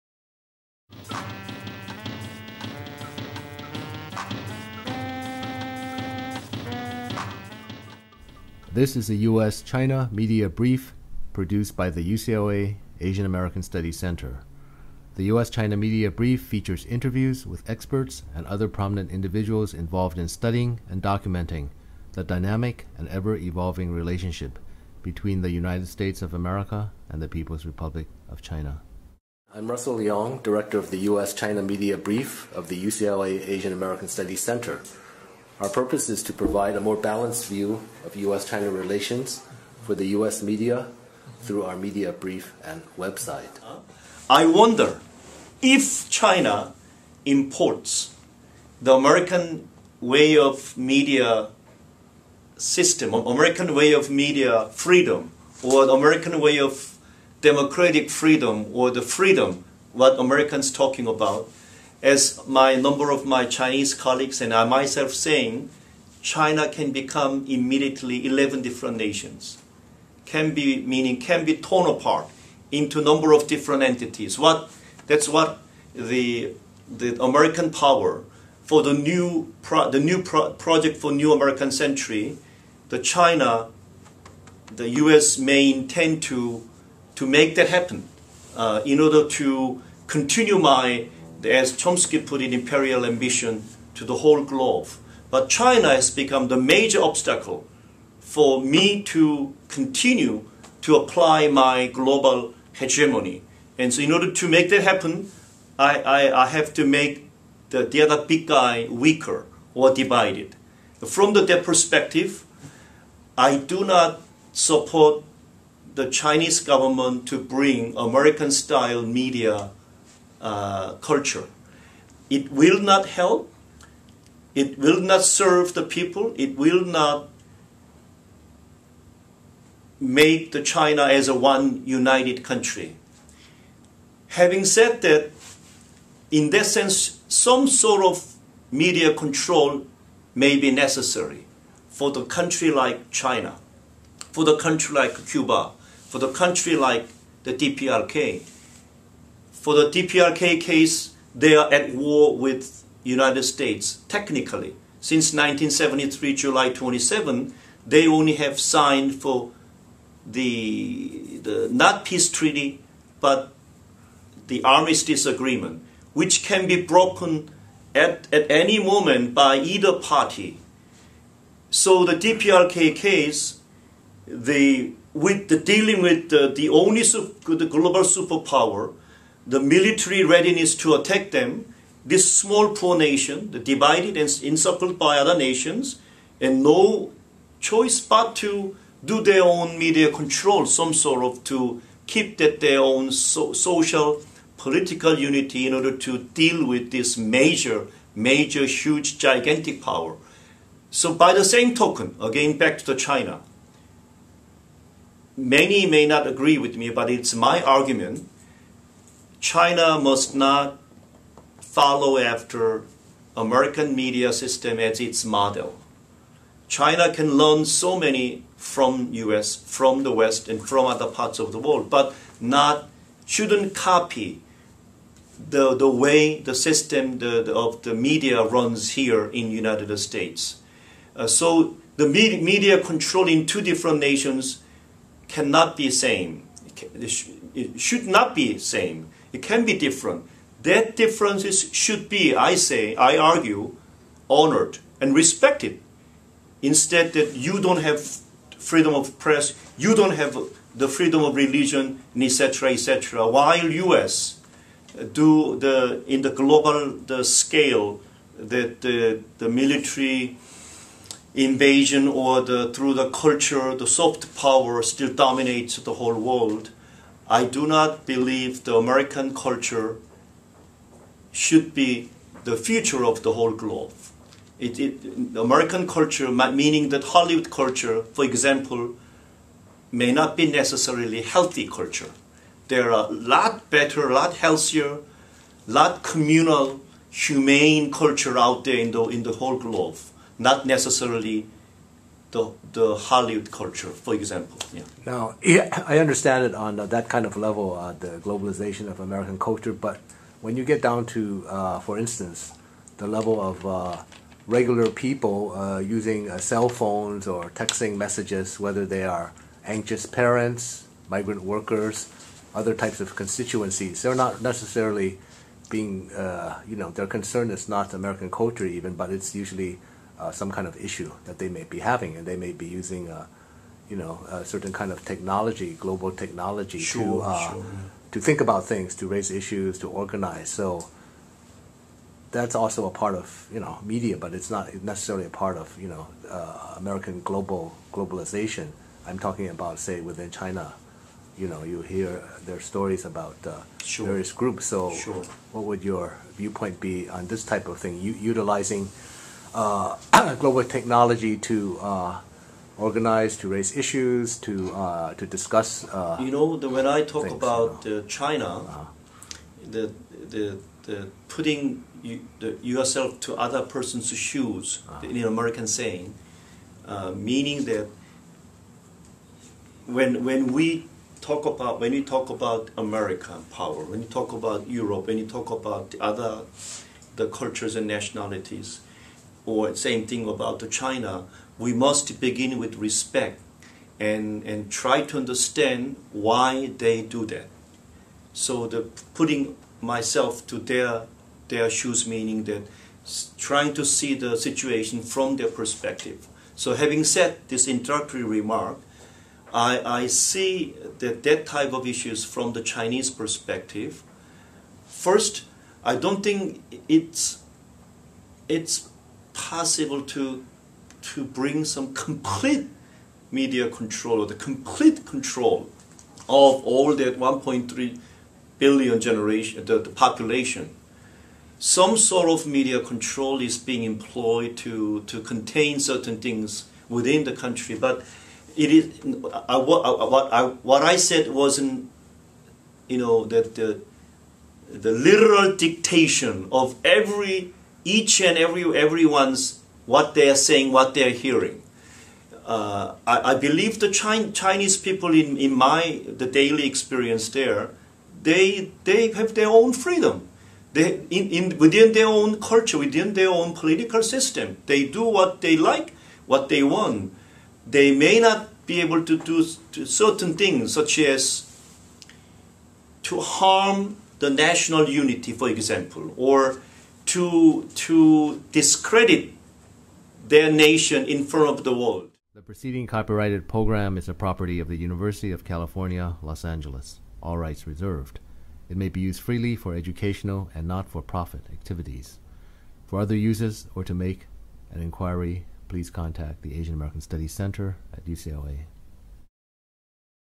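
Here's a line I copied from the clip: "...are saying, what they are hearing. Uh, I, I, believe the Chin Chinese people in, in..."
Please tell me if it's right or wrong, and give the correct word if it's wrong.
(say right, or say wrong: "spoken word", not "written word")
right.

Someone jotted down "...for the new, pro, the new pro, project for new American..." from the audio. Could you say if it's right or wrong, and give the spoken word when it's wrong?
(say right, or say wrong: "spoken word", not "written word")
right.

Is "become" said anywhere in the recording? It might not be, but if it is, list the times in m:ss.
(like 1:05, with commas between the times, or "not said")
1:06, 1:36.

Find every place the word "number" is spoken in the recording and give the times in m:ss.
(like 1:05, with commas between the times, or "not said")
1:02, 1:13.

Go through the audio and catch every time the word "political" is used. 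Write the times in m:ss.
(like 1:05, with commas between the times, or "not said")
3:14, 7:33.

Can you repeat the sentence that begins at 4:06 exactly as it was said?
Instead that you don't have freedom of press, you don't have the freedom of religion, etc., etc.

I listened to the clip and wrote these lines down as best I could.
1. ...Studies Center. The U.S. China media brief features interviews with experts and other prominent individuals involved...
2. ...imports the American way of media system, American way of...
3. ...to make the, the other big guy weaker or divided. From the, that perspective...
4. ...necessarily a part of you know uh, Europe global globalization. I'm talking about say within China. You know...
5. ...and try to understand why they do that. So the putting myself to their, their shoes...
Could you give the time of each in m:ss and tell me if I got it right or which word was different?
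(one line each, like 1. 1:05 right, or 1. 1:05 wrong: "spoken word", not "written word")
1. 0:13 right
2. 0:47 right
3. 1:46 right
4. 5:34 wrong: "American", not "Europe"
5. 6:24 right.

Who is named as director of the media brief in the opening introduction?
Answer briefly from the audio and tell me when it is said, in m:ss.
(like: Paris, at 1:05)
Russell Leong, at 0:29.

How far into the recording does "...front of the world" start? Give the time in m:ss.
7:51.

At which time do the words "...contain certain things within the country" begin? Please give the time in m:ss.
7:05.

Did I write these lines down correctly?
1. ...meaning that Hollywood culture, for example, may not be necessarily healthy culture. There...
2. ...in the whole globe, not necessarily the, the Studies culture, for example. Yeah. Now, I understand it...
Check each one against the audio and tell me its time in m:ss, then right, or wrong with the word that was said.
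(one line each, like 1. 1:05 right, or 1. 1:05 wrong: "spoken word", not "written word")
1. 4:36 right
2. 4:49 wrong: "Hollywood", not "Studies".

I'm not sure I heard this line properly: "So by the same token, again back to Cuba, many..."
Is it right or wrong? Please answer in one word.
wrong.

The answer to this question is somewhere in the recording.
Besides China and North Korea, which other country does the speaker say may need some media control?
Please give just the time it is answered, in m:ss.
2:25.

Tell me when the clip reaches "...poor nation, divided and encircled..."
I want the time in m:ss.
3:02.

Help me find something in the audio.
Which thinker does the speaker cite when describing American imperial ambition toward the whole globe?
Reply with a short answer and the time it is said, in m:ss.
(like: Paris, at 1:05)
Chomsky, at 1:31.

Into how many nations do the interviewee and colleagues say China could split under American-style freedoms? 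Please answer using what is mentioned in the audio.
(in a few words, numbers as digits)
11.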